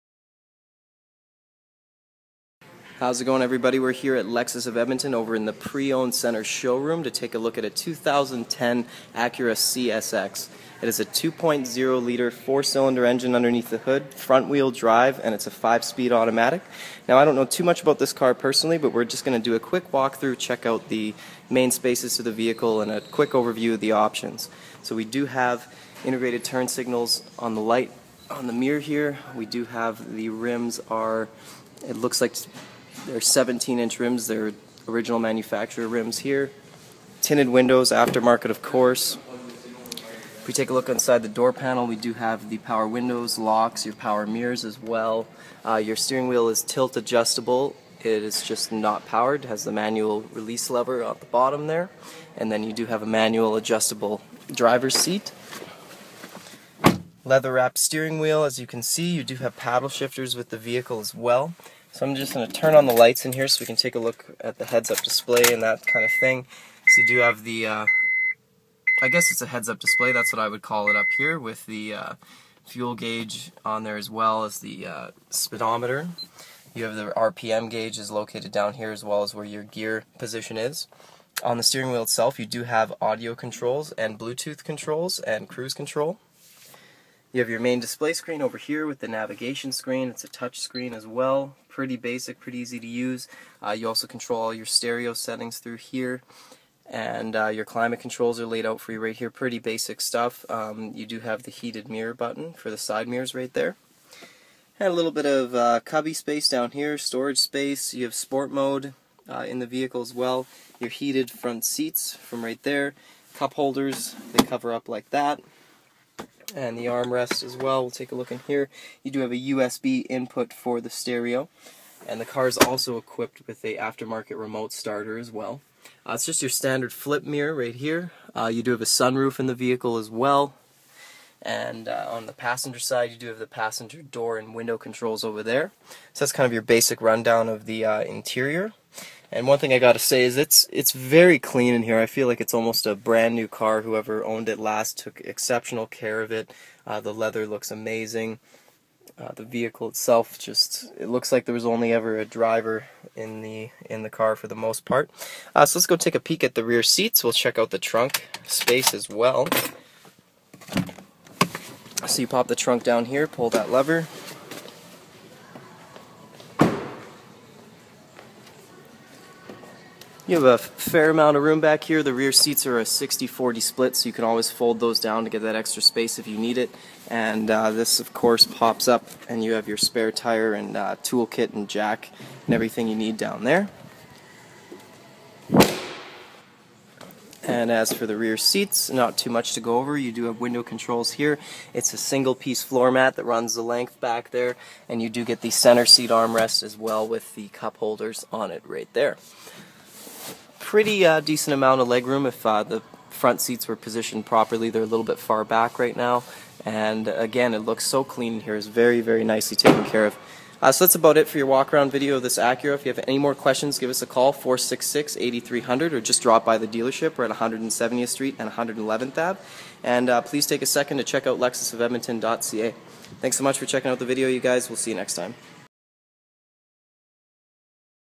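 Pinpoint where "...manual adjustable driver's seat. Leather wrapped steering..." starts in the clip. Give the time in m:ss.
0:53.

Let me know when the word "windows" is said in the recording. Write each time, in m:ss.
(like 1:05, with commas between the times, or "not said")
0:37, 0:42, 2:14, 3:10.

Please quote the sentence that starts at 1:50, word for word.
Your heated front seats from right there.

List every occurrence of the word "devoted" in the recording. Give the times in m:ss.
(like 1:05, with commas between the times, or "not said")
not said.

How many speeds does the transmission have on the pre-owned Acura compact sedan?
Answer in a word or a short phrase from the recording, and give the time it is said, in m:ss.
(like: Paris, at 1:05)
5 speed automatic, at 0:15.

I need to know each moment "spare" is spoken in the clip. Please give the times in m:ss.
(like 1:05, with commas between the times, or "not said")
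2:59.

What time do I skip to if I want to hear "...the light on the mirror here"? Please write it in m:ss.
0:27.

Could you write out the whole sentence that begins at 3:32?
If you have any more questions, give us a call, 466 8300, or just drop by the dealership.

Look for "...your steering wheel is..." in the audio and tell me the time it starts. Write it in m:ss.
0:45.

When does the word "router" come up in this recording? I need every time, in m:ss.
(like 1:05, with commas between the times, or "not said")
not said.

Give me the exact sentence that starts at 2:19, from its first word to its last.
And one thing I gotta say is it's it's very clean in here.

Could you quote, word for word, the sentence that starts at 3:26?
And again, it looks so clean here, is here.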